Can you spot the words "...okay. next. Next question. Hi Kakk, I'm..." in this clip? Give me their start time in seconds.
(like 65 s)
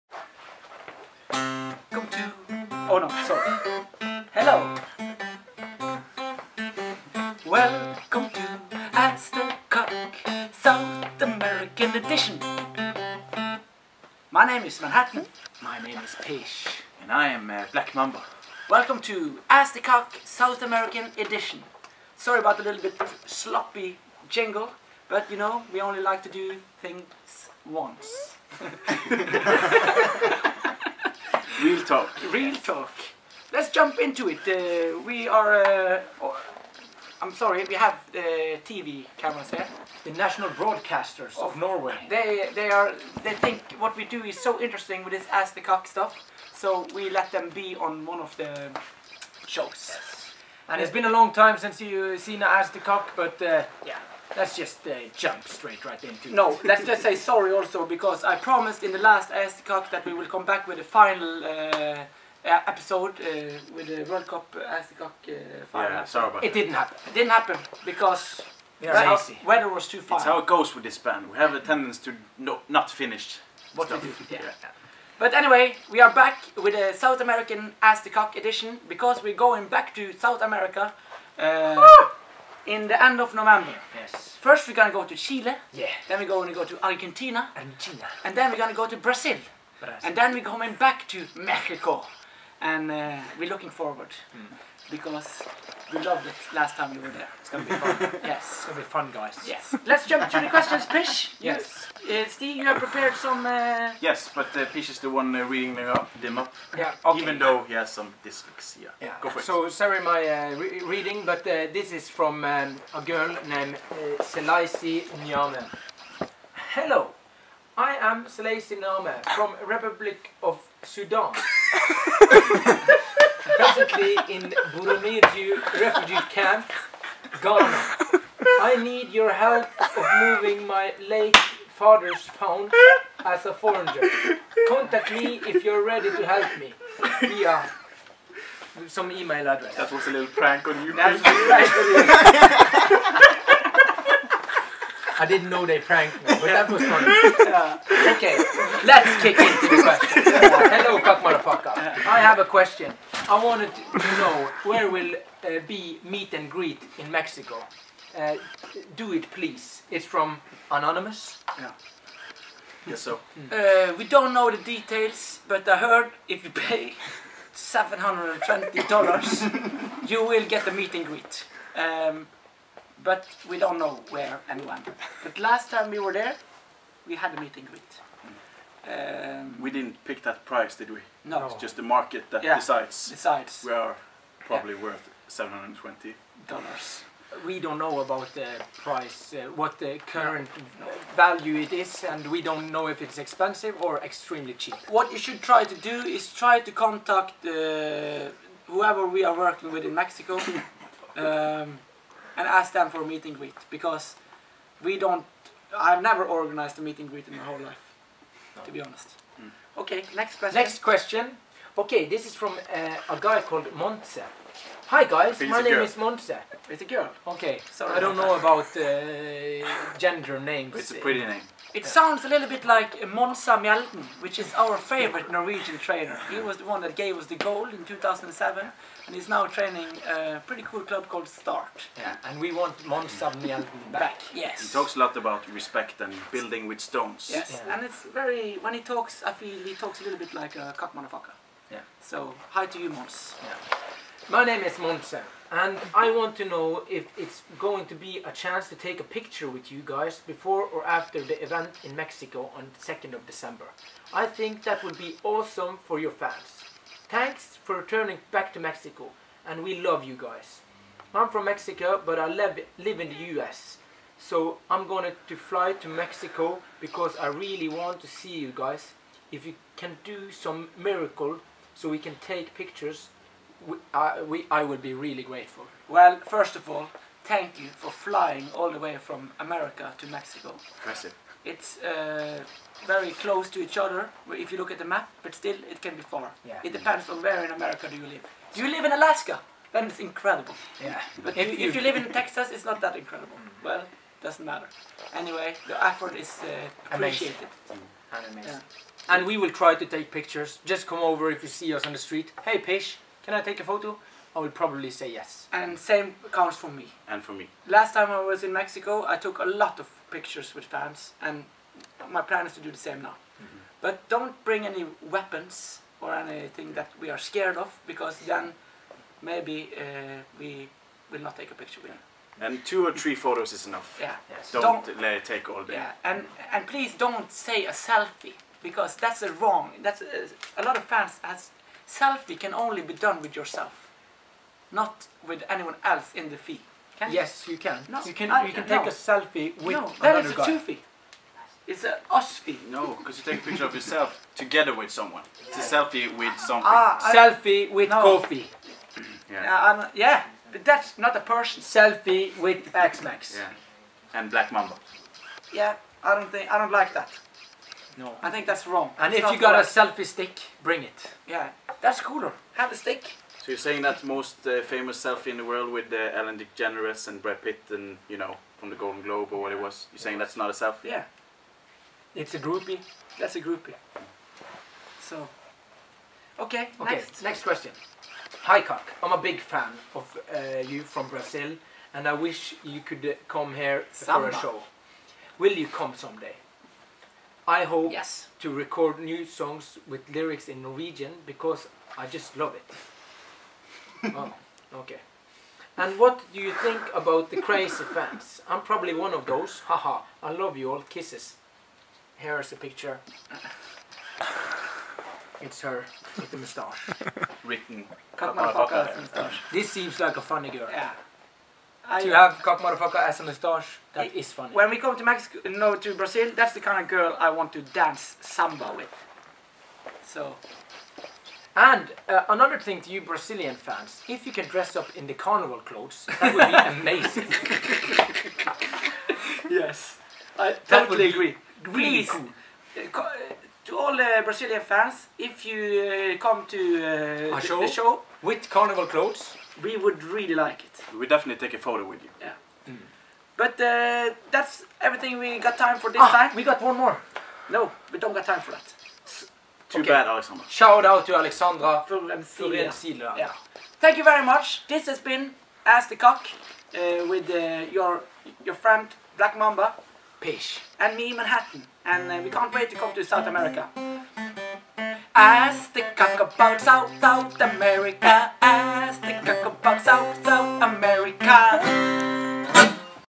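376 s.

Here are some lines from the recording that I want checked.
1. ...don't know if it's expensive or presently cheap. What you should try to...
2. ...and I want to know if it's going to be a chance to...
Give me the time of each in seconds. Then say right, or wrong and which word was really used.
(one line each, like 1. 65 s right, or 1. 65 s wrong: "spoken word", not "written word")
1. 192 s wrong: "extremely", not "presently"
2. 245 s right.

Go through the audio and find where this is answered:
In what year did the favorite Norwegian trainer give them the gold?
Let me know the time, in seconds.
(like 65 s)
227 s.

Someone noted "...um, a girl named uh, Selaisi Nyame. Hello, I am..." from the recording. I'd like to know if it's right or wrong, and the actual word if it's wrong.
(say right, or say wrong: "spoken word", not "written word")
right.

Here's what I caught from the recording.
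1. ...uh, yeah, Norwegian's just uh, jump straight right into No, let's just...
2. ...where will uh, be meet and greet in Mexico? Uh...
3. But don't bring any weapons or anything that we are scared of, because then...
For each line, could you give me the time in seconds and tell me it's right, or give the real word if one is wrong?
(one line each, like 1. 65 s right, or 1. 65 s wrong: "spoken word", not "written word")
1. 53 s wrong: "Let", not "Norwegian"
2. 154 s right
3. 313 s right.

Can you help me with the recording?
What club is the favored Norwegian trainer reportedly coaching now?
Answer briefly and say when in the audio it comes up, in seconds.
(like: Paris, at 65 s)
Start, at 231 s.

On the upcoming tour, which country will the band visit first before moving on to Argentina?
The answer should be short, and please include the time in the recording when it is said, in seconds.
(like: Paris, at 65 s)
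Chile, at 85 s.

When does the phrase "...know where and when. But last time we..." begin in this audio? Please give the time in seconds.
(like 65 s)
173 s.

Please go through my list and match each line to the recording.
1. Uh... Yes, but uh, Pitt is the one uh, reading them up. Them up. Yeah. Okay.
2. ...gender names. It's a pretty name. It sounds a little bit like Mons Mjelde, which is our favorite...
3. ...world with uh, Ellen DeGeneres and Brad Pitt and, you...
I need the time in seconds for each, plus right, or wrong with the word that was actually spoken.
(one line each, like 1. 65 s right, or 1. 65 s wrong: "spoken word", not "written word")
1. 103 s wrong: "Pish", not "Pitt"
2. 219 s right
3. 365 s right.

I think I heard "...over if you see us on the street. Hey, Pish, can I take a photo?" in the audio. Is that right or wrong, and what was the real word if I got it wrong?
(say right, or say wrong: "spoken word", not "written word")
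right.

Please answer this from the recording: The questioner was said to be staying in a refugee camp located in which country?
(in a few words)
Ghana.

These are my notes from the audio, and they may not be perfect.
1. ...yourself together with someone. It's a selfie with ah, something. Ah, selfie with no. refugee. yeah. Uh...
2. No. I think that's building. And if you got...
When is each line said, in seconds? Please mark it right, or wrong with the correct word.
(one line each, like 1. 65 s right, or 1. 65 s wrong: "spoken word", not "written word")
1. 343 s wrong: "coffee", not "refugee"
2. 357 s wrong: "wrong", not "building".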